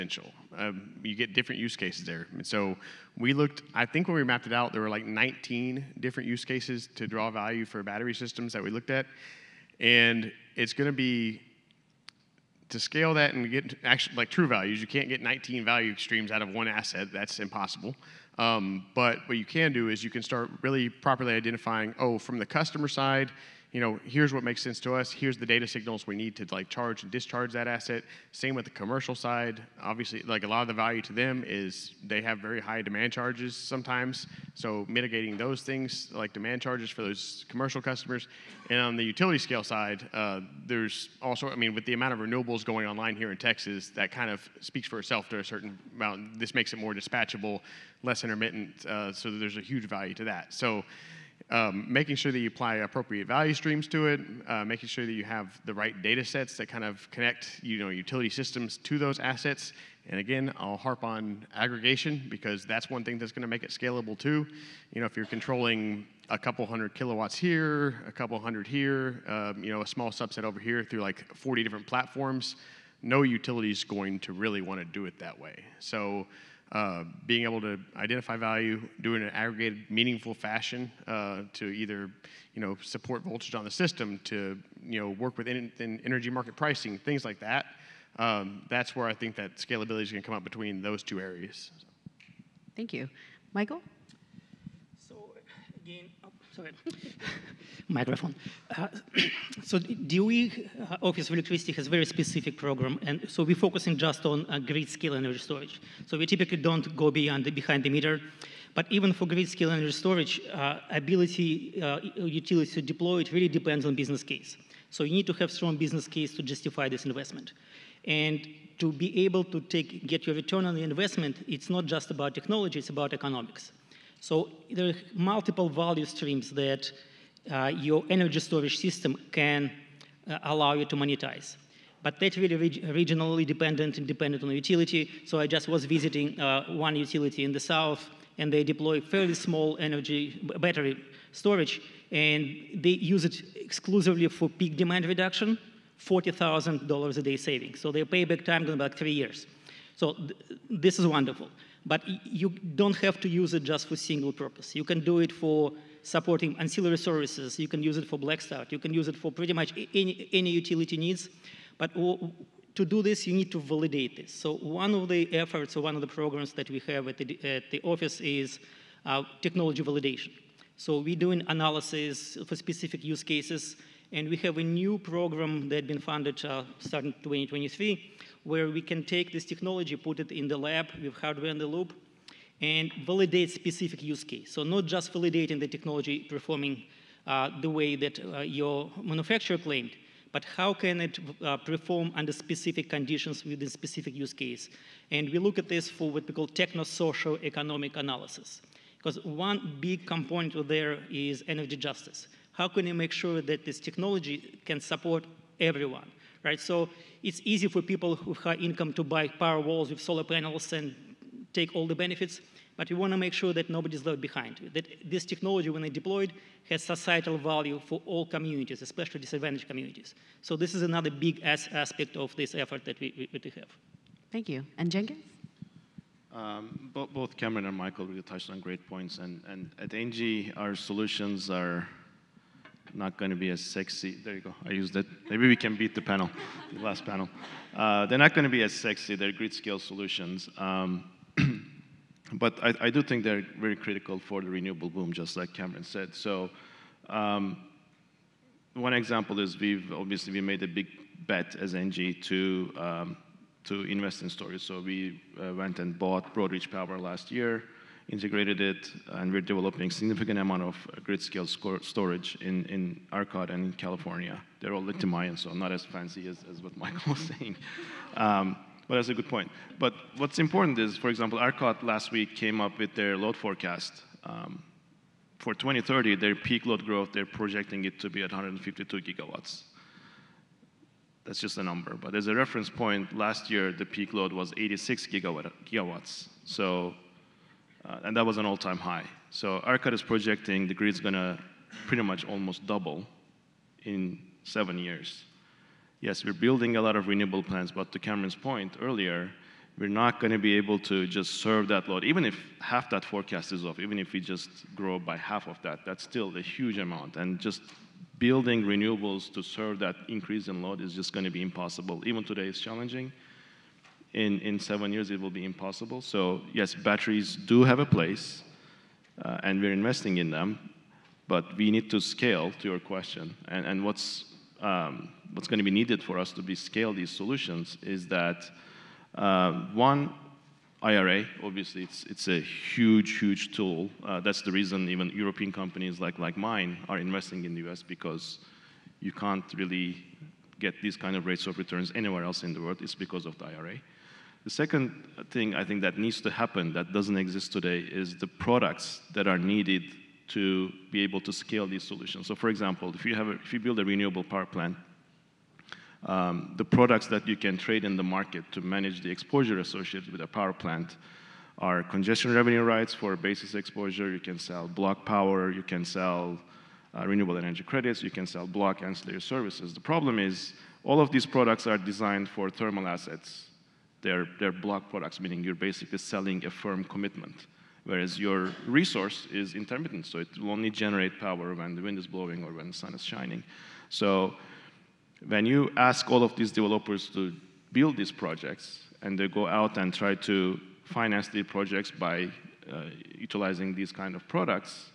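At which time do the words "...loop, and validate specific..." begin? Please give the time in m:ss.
3:01.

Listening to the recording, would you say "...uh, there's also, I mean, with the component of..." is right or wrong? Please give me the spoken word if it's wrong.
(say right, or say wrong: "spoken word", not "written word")
wrong: "amount", not "component".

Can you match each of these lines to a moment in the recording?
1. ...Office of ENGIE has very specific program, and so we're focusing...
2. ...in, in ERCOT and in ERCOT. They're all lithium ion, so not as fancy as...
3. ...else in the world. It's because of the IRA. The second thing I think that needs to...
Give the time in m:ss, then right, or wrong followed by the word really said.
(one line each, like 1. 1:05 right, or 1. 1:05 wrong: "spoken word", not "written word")
1. 1:40 wrong: "Electricity", not "ENGIE"
2. 4:22 wrong: "California", not "ERCOT"
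3. 5:42 right.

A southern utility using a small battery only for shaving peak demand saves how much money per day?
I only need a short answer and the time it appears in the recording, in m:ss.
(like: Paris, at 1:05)
$40,000, at 2:25.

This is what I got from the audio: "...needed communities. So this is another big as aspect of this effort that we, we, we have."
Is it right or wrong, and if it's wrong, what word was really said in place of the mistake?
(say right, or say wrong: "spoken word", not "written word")
wrong: "disadvantaged", not "needed".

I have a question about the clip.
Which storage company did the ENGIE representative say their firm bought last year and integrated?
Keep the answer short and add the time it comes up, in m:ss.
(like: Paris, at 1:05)
Broadreach Power, at 4:16.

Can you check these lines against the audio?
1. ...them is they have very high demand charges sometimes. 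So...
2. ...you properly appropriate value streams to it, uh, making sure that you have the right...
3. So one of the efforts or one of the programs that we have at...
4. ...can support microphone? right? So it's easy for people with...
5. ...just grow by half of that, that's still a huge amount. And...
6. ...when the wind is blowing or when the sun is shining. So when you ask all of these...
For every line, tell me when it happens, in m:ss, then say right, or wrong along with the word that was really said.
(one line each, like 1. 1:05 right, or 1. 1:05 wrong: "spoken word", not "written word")
1. 0:31 right
2. 0:52 wrong: "apply", not "properly"
3. 2:44 right
4. 3:24 wrong: "everyone", not "microphone"
5. 5:04 right
6. 6:21 right.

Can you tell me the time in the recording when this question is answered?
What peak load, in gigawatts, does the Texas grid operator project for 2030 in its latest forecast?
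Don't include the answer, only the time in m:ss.
4:38.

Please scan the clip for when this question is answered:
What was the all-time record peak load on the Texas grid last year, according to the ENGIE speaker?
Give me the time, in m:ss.
4:44.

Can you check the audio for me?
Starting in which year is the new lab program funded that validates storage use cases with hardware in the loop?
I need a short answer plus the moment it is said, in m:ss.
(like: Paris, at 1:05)
2023, at 2:57.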